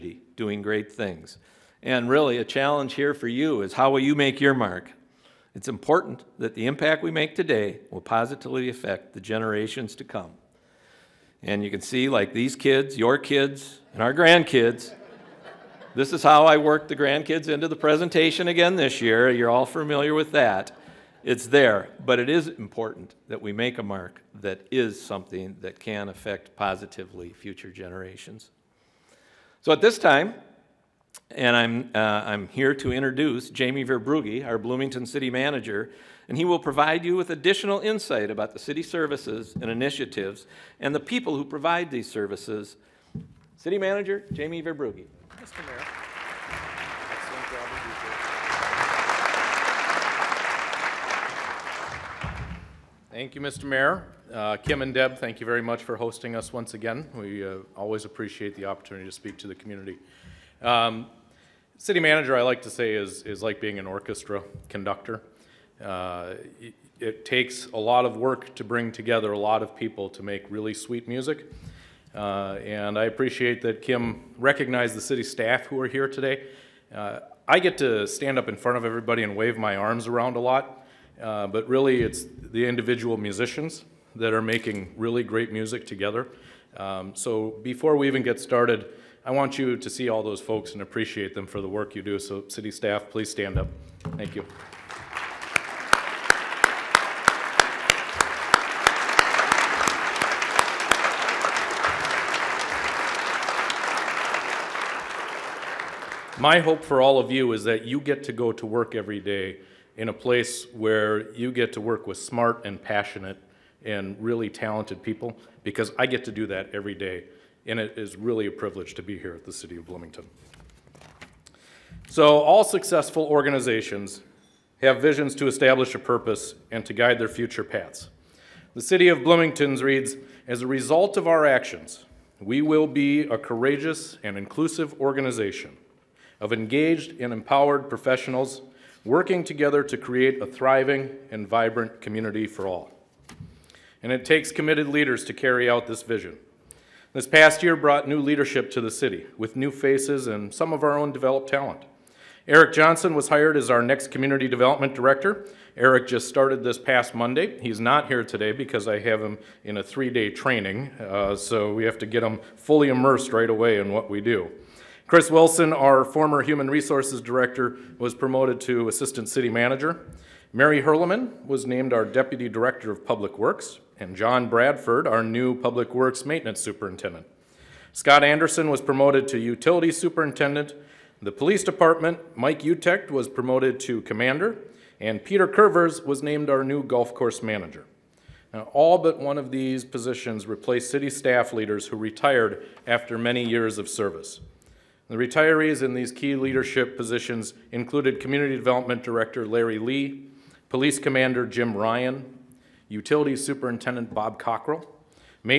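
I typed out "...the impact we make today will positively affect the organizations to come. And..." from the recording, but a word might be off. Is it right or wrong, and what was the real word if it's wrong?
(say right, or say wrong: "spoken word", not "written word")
wrong: "generations", not "organizations".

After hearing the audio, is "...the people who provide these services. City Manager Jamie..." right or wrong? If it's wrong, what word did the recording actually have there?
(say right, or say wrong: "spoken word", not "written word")
right.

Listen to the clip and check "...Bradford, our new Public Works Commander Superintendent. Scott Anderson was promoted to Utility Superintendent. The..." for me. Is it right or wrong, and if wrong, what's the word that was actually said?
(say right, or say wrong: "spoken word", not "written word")
wrong: "Maintenance", not "Commander".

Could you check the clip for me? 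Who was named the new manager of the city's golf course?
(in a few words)
Peter Curvers.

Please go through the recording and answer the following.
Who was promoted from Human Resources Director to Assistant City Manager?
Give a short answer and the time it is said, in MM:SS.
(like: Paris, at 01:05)
Chris Wilson, at 02:45.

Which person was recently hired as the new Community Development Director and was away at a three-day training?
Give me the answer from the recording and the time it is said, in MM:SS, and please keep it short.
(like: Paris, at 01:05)
Eric Johnson, at 02:32.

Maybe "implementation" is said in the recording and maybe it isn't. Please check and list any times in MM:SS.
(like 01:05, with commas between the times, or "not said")
not said.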